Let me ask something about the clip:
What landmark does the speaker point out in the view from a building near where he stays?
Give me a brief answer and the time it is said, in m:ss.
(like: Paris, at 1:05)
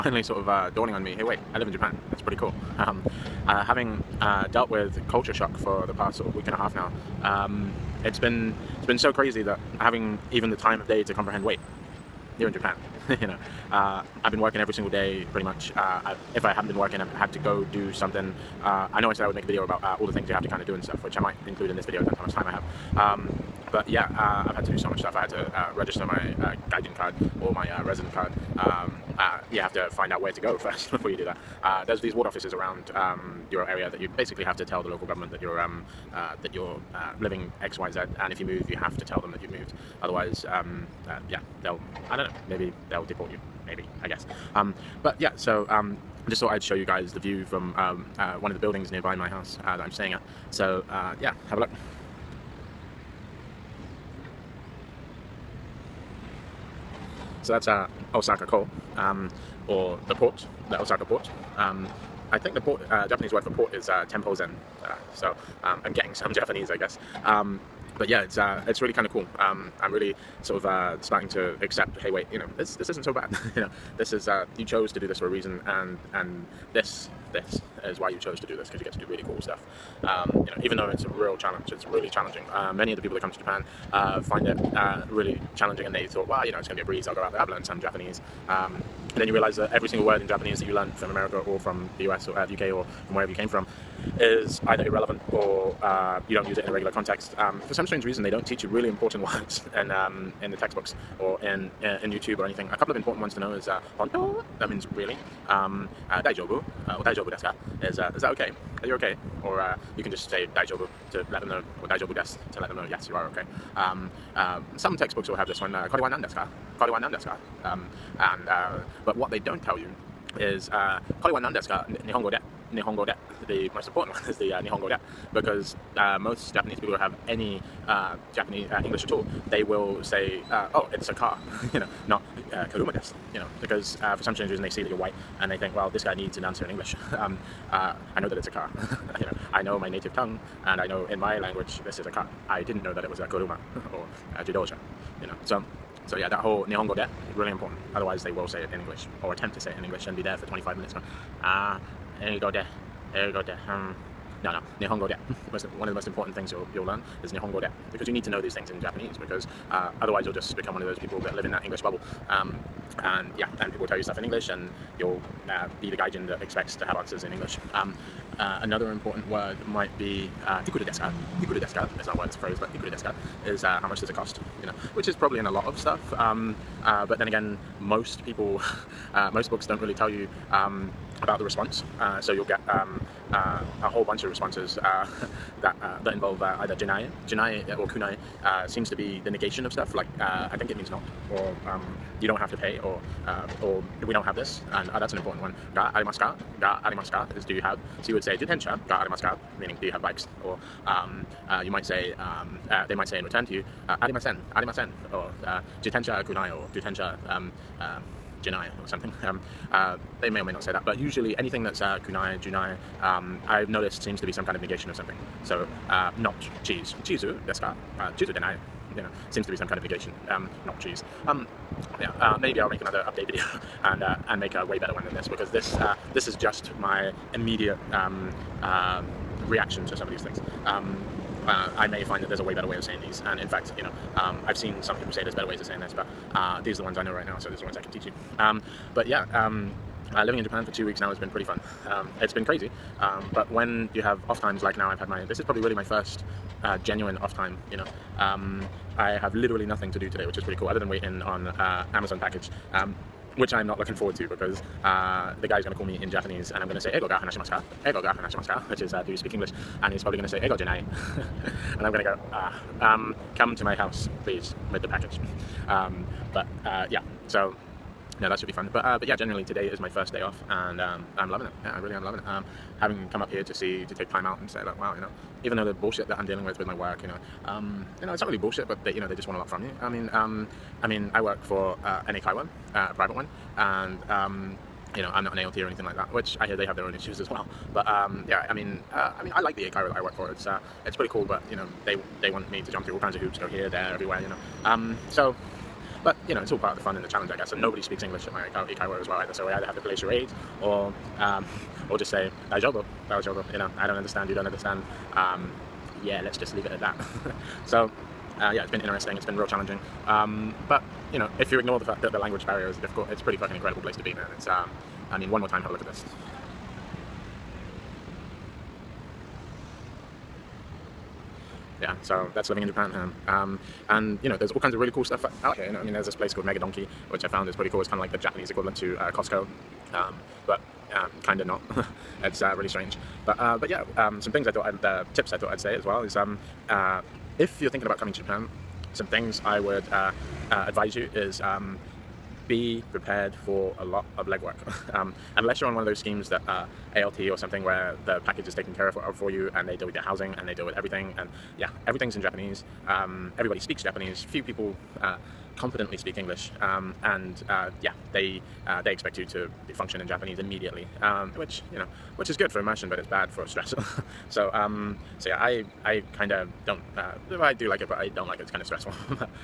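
Osaka port, at 1:00.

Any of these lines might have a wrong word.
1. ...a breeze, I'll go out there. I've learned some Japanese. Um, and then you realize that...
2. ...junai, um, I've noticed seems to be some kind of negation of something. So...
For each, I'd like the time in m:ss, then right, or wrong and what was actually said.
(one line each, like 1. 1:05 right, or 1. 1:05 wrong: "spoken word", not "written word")
1. 1:26 right
2. 3:32 right.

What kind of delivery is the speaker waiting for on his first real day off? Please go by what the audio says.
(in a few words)
Amazon package.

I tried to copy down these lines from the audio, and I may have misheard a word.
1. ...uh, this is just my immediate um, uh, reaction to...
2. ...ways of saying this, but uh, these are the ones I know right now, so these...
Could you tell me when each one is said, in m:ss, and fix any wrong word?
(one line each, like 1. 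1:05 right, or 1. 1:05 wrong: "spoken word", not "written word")
1. 3:45 right
2. 3:55 right.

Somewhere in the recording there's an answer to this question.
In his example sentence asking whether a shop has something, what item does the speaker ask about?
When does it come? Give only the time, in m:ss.
3:20.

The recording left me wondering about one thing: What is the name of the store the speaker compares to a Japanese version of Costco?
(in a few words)
Mega Donki.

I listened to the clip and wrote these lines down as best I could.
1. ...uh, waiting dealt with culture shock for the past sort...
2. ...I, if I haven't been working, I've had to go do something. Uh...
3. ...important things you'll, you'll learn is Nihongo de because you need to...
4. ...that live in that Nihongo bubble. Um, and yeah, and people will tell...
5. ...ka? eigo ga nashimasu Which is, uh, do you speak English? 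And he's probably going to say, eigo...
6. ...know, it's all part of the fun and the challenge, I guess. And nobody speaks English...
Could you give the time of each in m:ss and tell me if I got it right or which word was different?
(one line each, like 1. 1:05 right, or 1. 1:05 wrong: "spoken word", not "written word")
1. 0:03 wrong: "having", not "waiting"
2. 0:15 right
3. 2:36 right
4. 2:41 wrong: "English", not "Nihongo"
5. 4:17 right
6. 4:56 right.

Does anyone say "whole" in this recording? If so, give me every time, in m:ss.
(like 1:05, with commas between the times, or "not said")
2:26, 3:03.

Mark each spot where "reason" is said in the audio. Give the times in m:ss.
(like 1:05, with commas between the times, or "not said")
1:15, 1:38, 2:14.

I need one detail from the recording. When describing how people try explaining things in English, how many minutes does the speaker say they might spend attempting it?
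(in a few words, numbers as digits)
25.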